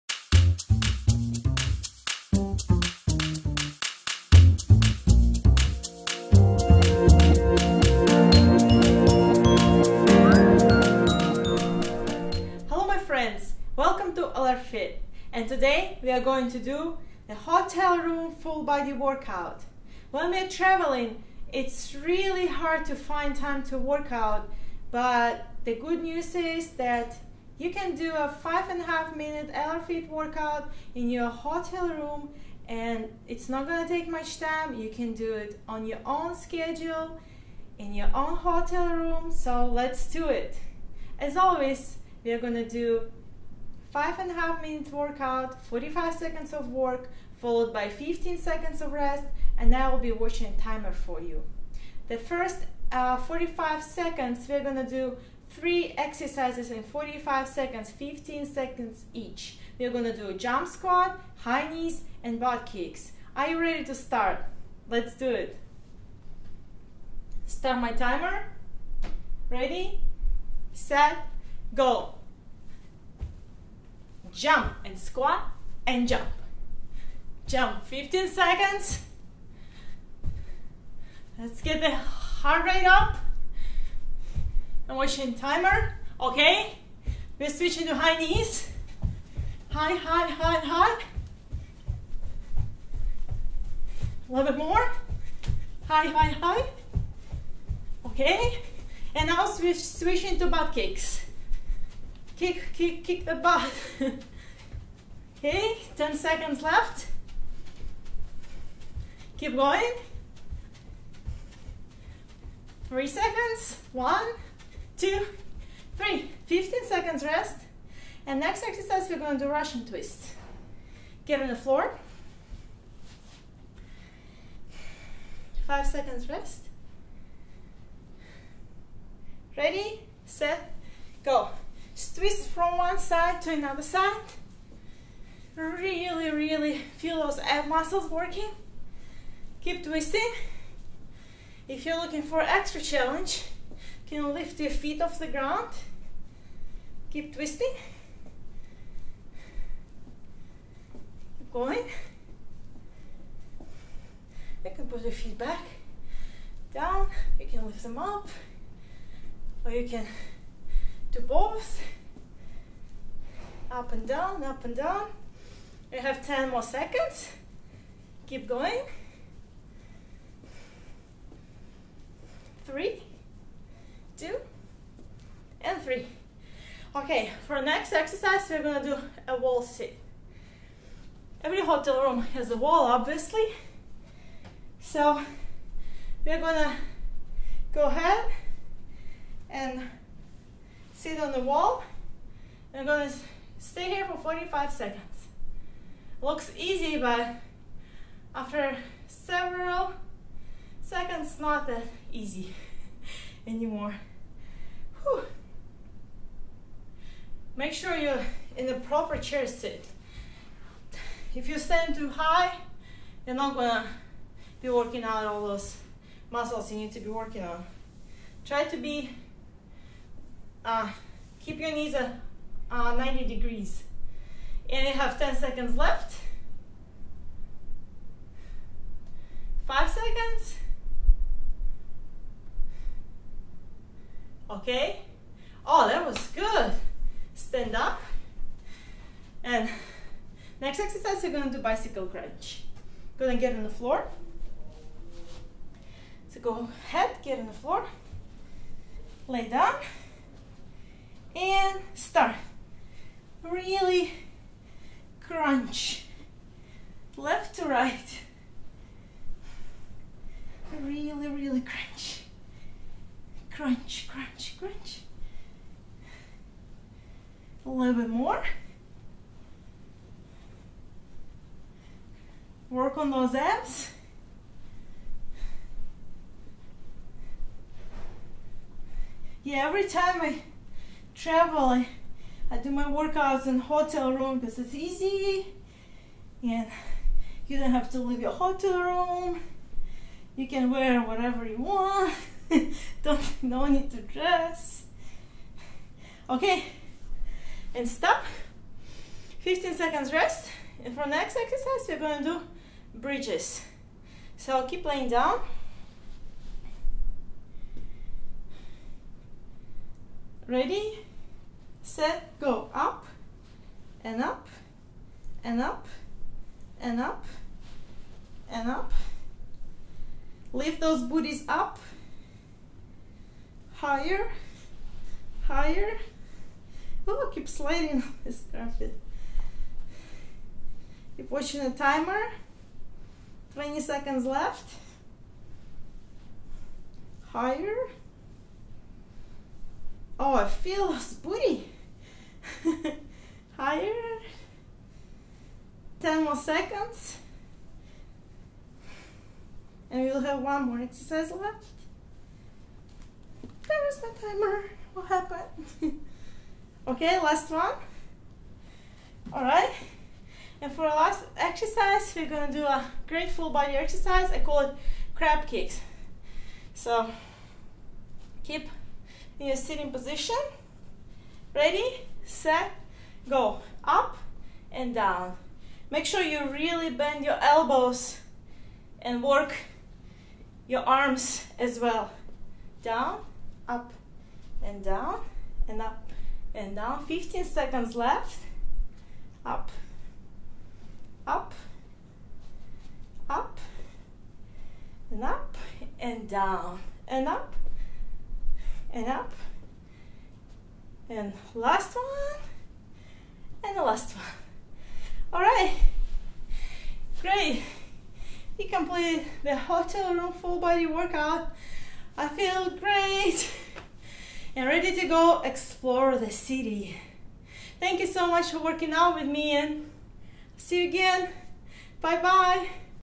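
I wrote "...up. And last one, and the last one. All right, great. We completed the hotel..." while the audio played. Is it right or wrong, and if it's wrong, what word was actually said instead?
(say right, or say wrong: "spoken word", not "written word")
right.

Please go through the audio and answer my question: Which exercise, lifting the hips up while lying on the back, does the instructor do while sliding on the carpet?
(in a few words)
Bridges.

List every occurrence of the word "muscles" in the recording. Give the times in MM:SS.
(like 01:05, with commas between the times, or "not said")
02:17, 03:36.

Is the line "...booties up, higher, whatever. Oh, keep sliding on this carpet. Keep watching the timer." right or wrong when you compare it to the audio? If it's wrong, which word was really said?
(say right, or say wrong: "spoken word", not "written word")
wrong: "higher", not "whatever".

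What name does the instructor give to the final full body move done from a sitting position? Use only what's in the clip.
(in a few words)
Crab kicks.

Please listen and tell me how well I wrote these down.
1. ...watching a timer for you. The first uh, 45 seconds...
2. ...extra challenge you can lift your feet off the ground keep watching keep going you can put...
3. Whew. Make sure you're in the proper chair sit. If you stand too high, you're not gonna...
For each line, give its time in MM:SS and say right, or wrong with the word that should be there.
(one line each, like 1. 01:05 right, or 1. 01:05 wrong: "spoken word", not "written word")
1. 00:50 right
2. 02:22 wrong: "twisting", not "watching"
3. 03:25 right.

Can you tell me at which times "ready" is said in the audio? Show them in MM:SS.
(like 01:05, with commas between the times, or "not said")
01:03, 01:09, 02:09, 05:10, 06:11, 06:54.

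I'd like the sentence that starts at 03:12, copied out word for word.
I'm gonna stay here for 45 seconds.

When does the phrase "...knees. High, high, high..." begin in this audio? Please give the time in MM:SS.
01:28.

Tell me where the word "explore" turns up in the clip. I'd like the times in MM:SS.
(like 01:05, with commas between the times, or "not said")
06:55.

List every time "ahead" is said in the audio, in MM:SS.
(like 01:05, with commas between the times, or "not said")
03:07, 04:06.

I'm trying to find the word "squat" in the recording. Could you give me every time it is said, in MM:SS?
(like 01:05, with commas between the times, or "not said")
01:00, 01:14.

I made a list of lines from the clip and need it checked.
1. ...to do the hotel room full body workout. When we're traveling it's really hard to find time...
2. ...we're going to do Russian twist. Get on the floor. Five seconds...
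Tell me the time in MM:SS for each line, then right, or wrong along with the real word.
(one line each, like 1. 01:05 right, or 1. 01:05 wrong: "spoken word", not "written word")
1. 00:16 right
2. 01:59 right.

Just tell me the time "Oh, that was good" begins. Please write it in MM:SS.
03:55.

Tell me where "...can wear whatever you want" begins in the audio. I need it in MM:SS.
04:50.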